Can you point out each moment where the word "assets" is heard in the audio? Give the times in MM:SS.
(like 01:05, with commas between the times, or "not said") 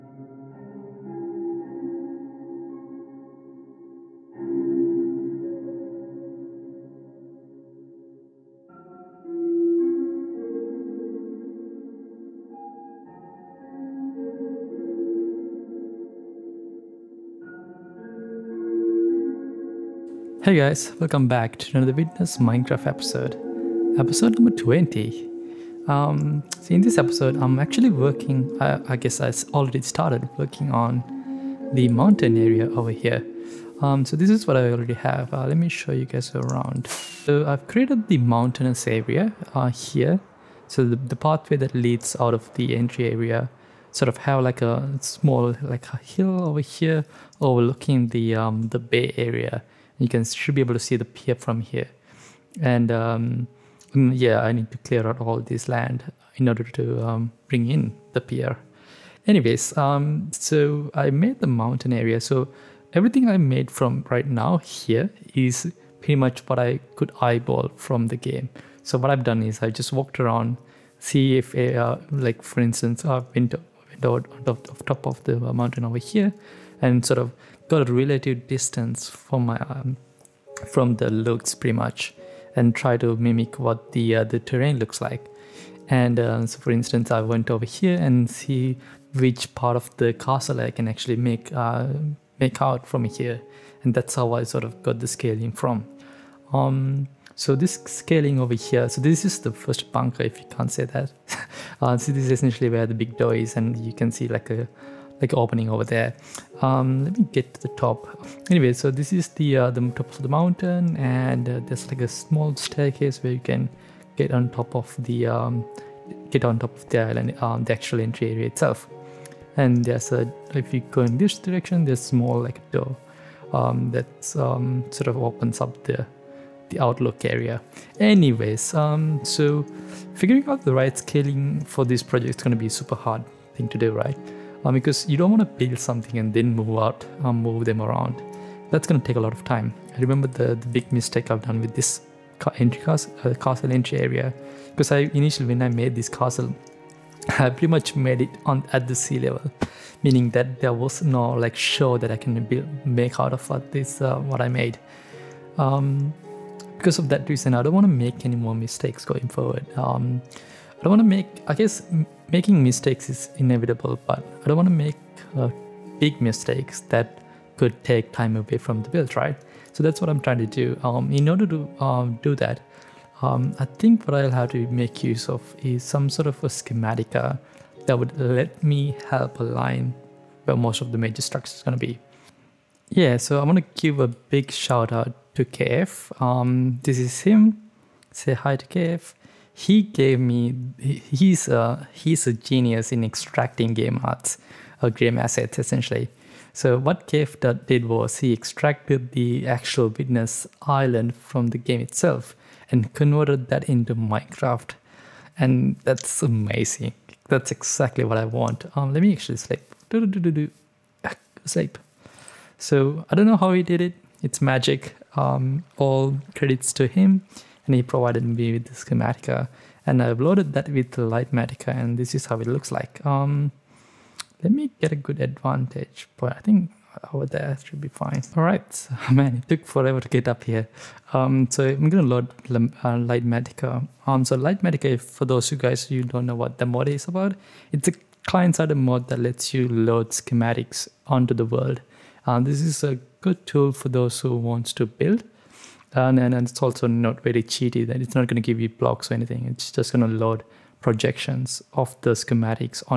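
03:15.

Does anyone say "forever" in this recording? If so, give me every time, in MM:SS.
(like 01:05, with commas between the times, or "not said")
03:49.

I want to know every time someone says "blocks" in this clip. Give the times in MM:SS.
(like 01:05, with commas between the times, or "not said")
04:08.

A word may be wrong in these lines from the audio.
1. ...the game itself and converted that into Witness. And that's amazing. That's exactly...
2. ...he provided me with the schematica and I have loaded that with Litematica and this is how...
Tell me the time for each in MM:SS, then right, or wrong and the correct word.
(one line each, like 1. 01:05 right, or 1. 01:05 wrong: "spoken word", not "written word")
1. 03:21 wrong: "Minecraft", not "Witness"
2. 03:37 right.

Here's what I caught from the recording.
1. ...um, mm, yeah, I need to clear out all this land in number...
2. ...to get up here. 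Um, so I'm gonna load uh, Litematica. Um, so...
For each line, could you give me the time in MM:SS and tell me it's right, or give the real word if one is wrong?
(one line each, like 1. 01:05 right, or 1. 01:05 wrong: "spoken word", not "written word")
1. 00:52 wrong: "order", not "number"
2. 03:49 right.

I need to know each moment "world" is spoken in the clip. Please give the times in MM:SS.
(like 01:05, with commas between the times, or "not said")
04:01.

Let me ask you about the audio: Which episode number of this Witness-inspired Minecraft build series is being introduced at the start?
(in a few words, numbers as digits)
20.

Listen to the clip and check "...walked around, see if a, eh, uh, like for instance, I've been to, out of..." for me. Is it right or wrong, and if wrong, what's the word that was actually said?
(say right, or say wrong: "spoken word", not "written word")
right.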